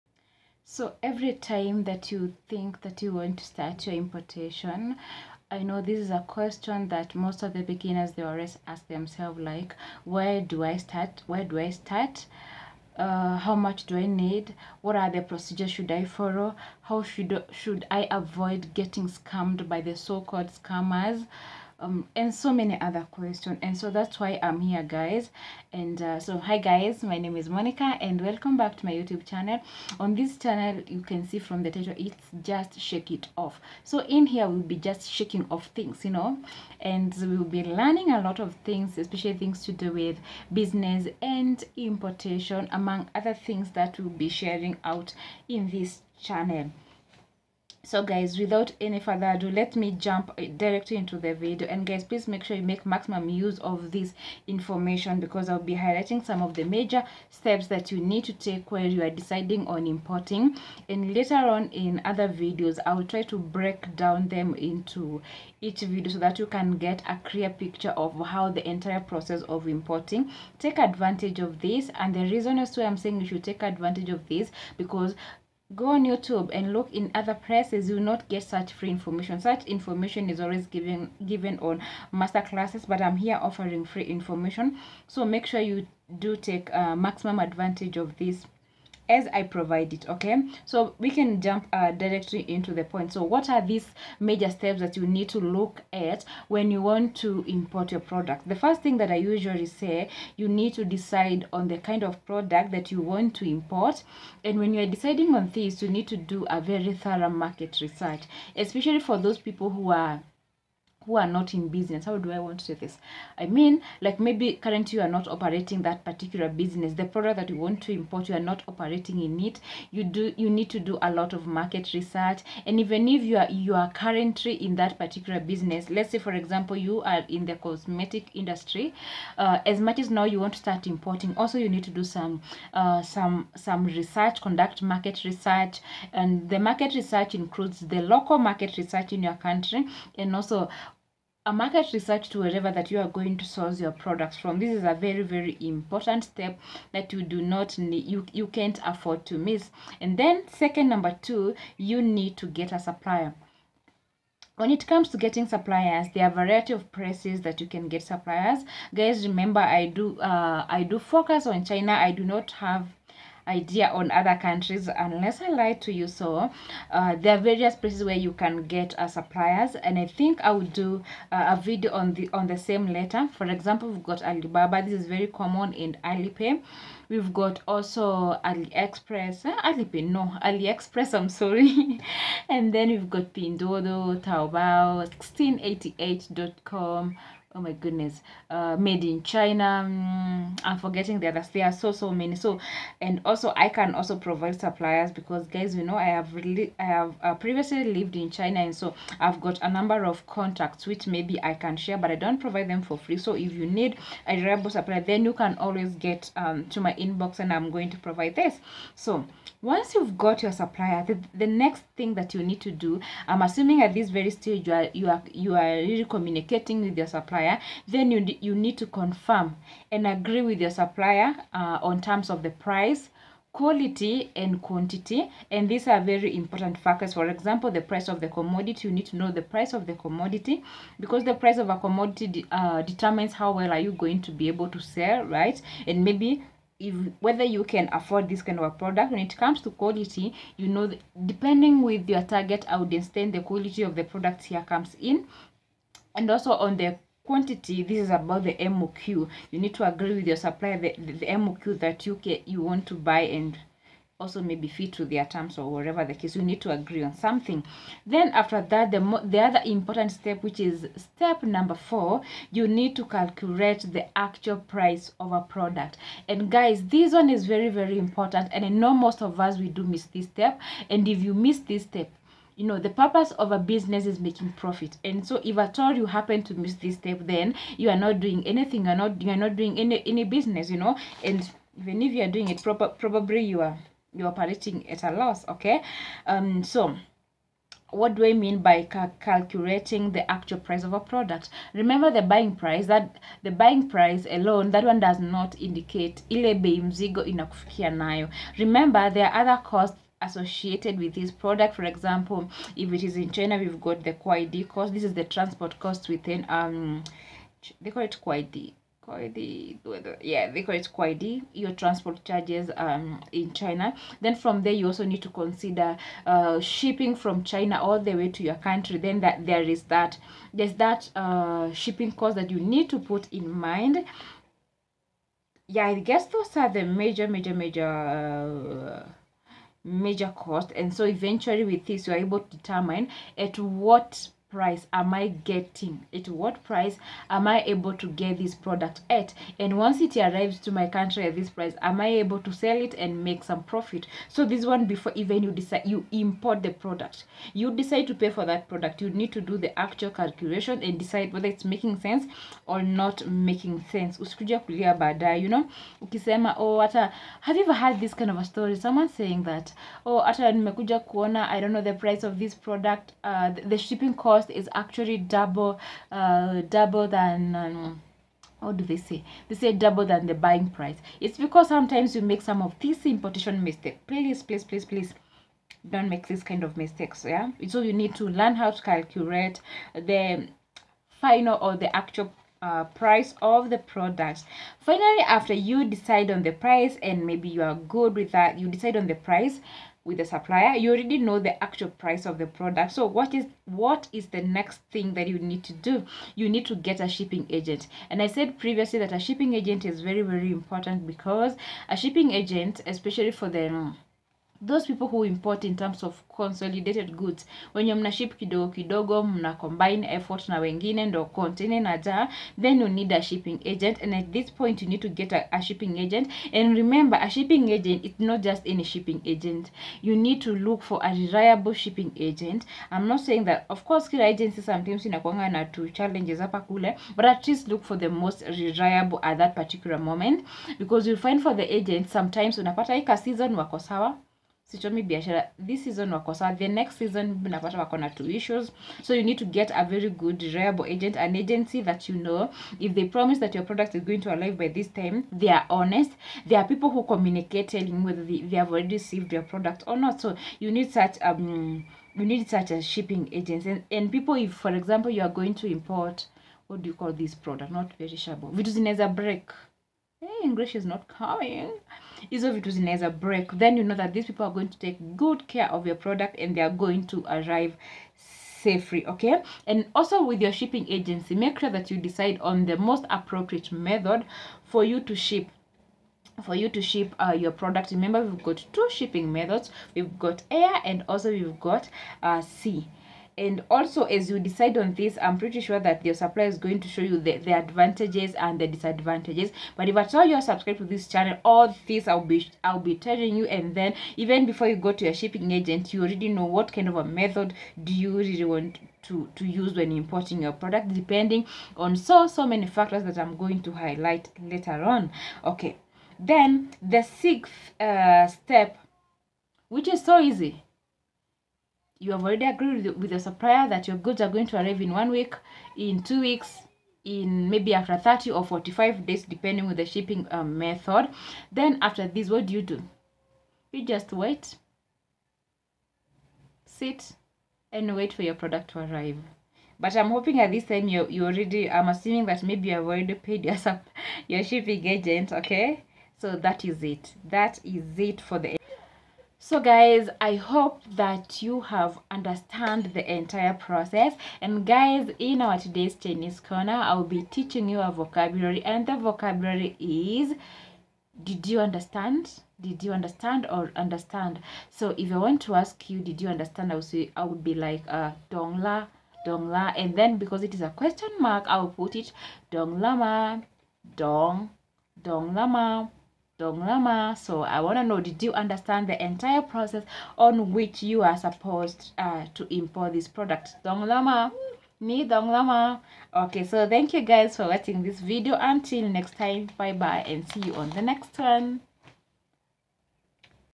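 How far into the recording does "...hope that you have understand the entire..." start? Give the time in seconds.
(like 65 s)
540 s.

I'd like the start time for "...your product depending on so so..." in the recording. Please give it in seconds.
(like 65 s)
500 s.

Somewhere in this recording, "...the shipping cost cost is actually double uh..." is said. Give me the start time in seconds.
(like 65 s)
363 s.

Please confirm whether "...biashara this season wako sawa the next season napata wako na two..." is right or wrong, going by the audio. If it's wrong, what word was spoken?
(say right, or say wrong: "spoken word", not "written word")
right.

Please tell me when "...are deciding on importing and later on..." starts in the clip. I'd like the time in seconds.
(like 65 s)
59 s.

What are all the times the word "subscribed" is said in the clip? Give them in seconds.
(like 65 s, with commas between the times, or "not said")
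490 s.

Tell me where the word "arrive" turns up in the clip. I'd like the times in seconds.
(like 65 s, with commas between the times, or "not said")
340 s, 444 s, 467 s, 514 s, 528 s.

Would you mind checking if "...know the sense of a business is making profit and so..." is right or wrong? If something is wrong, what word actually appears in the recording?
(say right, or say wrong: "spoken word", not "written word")
wrong: "purpose", not "sense".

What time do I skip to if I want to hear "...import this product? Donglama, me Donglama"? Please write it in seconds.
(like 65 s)
572 s.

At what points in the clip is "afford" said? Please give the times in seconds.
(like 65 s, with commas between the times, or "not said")
148 s, 237 s.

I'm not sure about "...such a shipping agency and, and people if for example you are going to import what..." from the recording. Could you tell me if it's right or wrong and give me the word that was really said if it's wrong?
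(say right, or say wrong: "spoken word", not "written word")
right.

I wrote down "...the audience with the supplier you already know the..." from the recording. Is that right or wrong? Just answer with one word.
wrong.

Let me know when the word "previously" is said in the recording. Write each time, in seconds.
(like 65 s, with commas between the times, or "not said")
197 s, 398 s.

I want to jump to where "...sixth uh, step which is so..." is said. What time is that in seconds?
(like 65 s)
507 s.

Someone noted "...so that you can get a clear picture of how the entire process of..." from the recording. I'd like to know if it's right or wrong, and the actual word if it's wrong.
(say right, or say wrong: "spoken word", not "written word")
right.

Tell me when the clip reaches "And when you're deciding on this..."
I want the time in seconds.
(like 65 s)
104 s.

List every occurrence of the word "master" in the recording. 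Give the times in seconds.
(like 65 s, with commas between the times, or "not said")
82 s.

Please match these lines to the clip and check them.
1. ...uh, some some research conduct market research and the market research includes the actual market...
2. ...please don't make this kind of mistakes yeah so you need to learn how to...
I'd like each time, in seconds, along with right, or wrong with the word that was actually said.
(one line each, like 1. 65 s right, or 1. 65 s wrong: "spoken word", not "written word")
1. 132 s wrong: "local", not "actual"
2. 374 s right.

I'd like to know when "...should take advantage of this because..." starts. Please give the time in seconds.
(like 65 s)
73 s.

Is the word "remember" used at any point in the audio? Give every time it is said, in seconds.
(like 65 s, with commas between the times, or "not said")
159 s, 291 s, 298 s, 416 s, 477 s.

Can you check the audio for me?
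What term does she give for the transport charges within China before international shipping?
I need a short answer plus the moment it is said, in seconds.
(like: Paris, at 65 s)
Quid cost, at 304 s.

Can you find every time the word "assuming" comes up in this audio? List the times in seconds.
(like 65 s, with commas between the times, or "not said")
213 s, 531 s.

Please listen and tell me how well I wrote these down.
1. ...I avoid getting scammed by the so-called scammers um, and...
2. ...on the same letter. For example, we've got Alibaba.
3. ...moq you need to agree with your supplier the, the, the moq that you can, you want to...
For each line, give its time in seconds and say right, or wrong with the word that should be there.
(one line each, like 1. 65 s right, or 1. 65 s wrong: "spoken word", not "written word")
1. 17 s right
2. 172 s right
3. 248 s right.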